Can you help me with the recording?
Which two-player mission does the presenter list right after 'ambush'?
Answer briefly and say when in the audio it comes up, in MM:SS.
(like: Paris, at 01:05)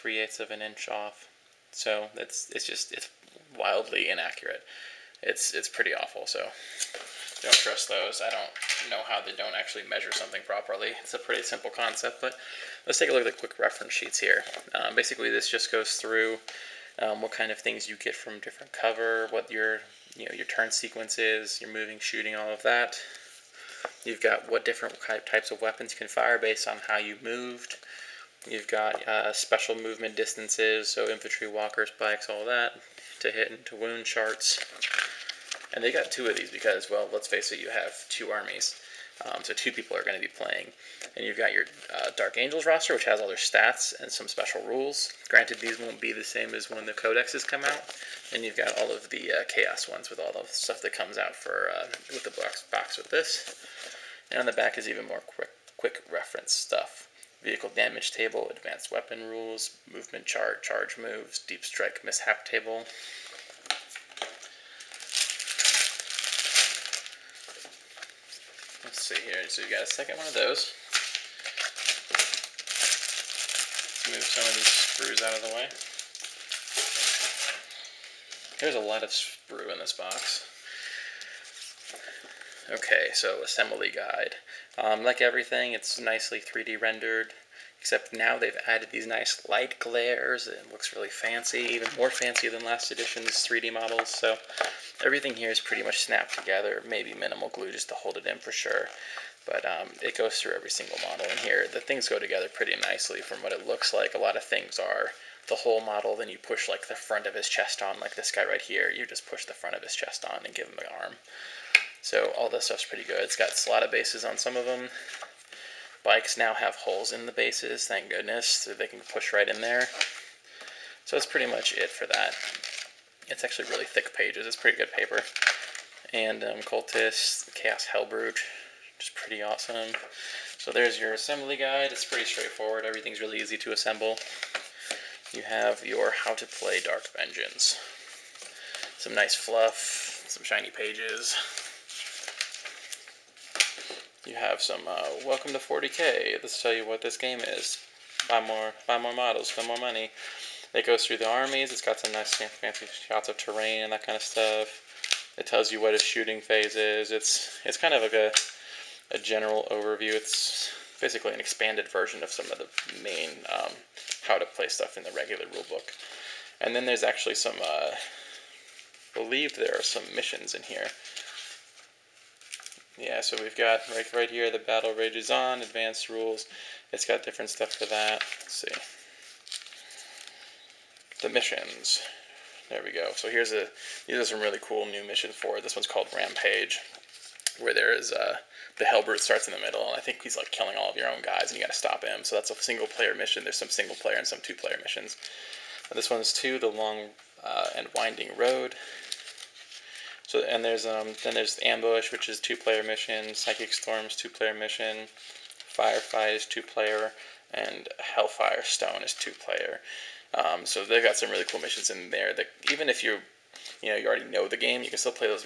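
Psychic storms, at 03:23.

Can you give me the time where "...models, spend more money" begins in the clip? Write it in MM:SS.
02:29.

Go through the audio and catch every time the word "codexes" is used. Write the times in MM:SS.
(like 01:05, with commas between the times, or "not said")
00:46.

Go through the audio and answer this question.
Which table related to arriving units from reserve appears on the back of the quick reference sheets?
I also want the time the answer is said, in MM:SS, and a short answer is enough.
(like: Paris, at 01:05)
Deep strike mishap table, at 01:01.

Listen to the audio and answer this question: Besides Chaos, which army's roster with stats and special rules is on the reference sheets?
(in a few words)
Dark Angels.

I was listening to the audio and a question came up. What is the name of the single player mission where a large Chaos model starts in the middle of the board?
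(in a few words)
Rampage.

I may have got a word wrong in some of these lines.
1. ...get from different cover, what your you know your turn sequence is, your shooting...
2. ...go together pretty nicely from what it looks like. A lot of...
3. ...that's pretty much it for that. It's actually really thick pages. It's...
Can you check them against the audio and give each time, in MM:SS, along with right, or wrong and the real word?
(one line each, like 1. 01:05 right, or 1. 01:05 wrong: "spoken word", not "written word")
1. 00:17 wrong: "moving", not "shooting"
2. 01:42 right
3. 02:01 right.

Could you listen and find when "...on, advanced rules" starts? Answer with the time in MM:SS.
02:55.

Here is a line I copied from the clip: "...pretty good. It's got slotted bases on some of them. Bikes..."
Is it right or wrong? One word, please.
right.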